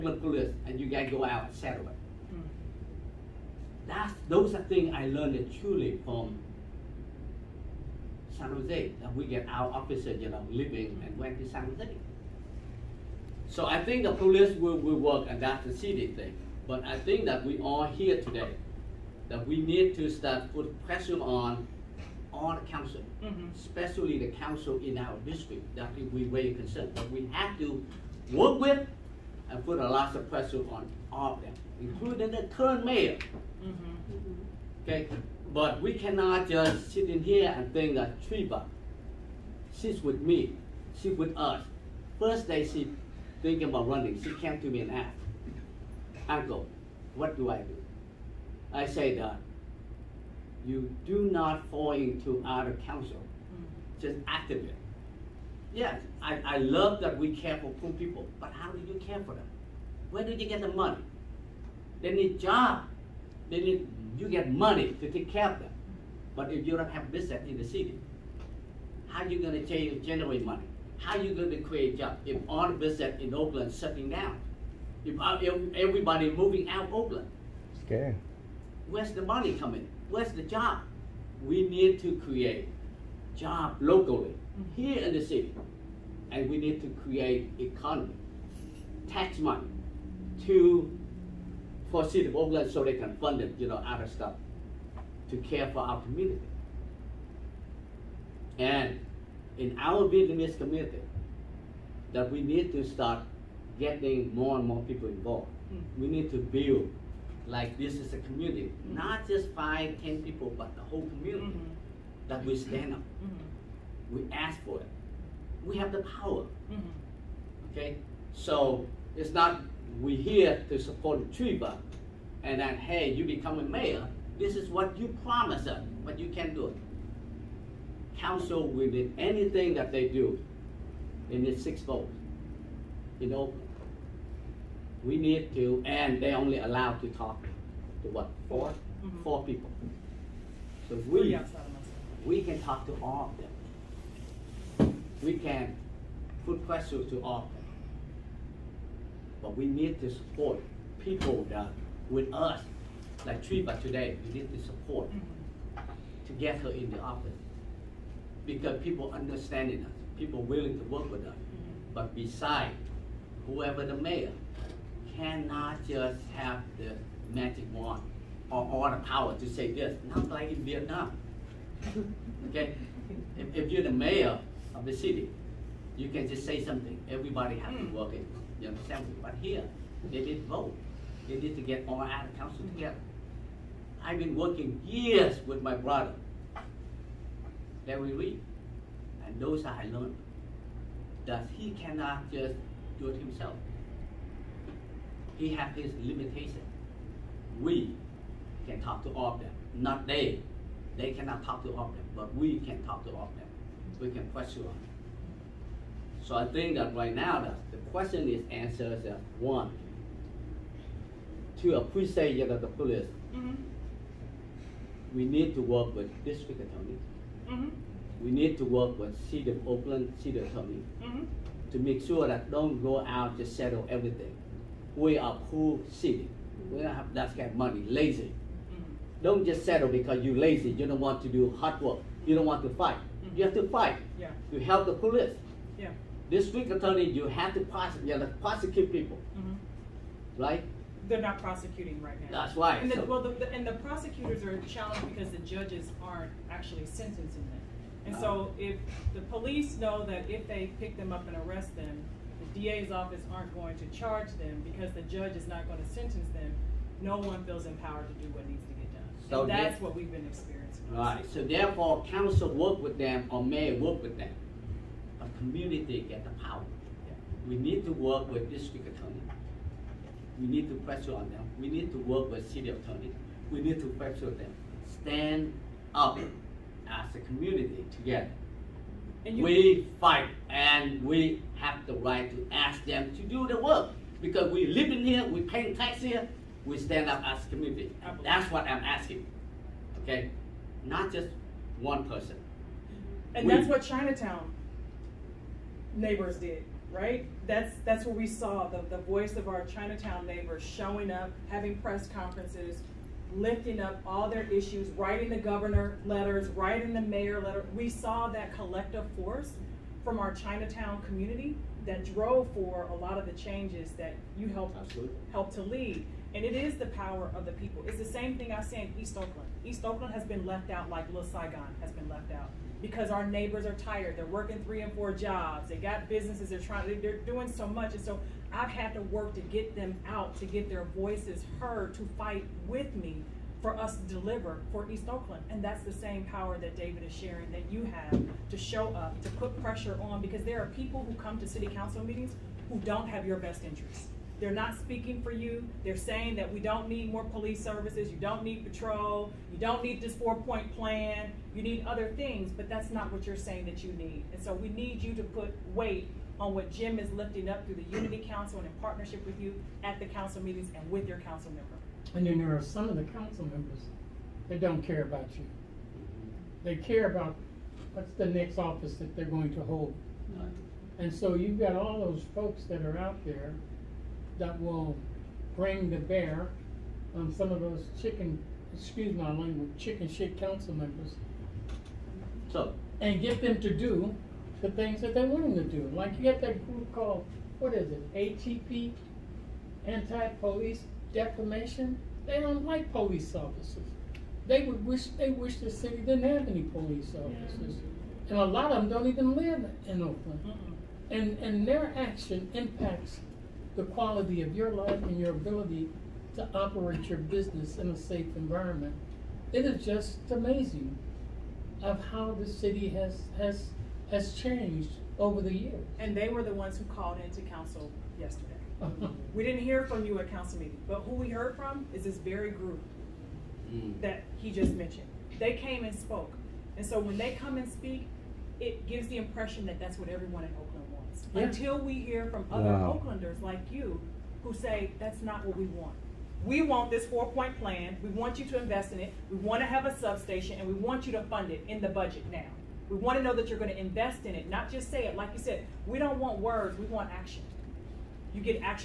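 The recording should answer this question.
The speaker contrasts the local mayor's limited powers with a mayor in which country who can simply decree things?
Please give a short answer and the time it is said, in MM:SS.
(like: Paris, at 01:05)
Vietnam, at 02:50.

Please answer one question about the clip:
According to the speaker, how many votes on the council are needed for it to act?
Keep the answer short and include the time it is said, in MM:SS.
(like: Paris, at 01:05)
6, at 02:11.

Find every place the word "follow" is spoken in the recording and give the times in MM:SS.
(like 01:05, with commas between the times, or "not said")
not said.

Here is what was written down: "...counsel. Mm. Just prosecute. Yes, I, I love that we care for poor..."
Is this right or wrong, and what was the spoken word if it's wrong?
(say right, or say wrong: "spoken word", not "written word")
wrong: "activate", not "prosecute".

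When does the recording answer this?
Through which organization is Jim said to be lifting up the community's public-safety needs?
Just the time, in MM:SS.
05:57.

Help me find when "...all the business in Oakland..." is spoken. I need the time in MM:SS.
01:12.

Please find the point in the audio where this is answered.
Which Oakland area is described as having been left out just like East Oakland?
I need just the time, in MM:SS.
05:21.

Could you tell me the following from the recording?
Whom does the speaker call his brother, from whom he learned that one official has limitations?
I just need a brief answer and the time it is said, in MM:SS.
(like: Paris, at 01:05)
Larry Reid, at 03:07.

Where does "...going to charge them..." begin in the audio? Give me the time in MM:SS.
04:13.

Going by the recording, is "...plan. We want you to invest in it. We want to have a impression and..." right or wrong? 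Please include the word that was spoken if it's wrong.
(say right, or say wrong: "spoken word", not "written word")
wrong: "substation", not "impression".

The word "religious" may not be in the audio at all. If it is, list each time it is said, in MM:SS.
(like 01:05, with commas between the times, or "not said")
not said.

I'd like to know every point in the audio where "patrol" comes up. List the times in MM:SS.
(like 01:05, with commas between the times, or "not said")
05:48.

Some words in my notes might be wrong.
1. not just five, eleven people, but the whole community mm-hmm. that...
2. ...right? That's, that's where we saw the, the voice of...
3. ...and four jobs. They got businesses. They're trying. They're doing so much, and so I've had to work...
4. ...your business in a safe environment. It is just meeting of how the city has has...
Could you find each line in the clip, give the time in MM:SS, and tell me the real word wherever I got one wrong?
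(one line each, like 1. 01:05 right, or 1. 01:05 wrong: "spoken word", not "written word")
1. 01:48 wrong: "ten", not "eleven"
2. 04:56 right
3. 05:24 right
4. 06:47 wrong: "amazing", not "meeting".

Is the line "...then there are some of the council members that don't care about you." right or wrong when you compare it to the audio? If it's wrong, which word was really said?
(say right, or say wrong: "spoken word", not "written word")
right.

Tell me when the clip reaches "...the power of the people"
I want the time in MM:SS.
05:16.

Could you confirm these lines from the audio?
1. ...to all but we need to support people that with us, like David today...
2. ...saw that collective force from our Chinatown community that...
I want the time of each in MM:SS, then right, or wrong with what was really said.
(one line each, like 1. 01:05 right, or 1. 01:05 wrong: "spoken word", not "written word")
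1. 02:27 wrong: "Treva", not "David"
2. 05:07 right.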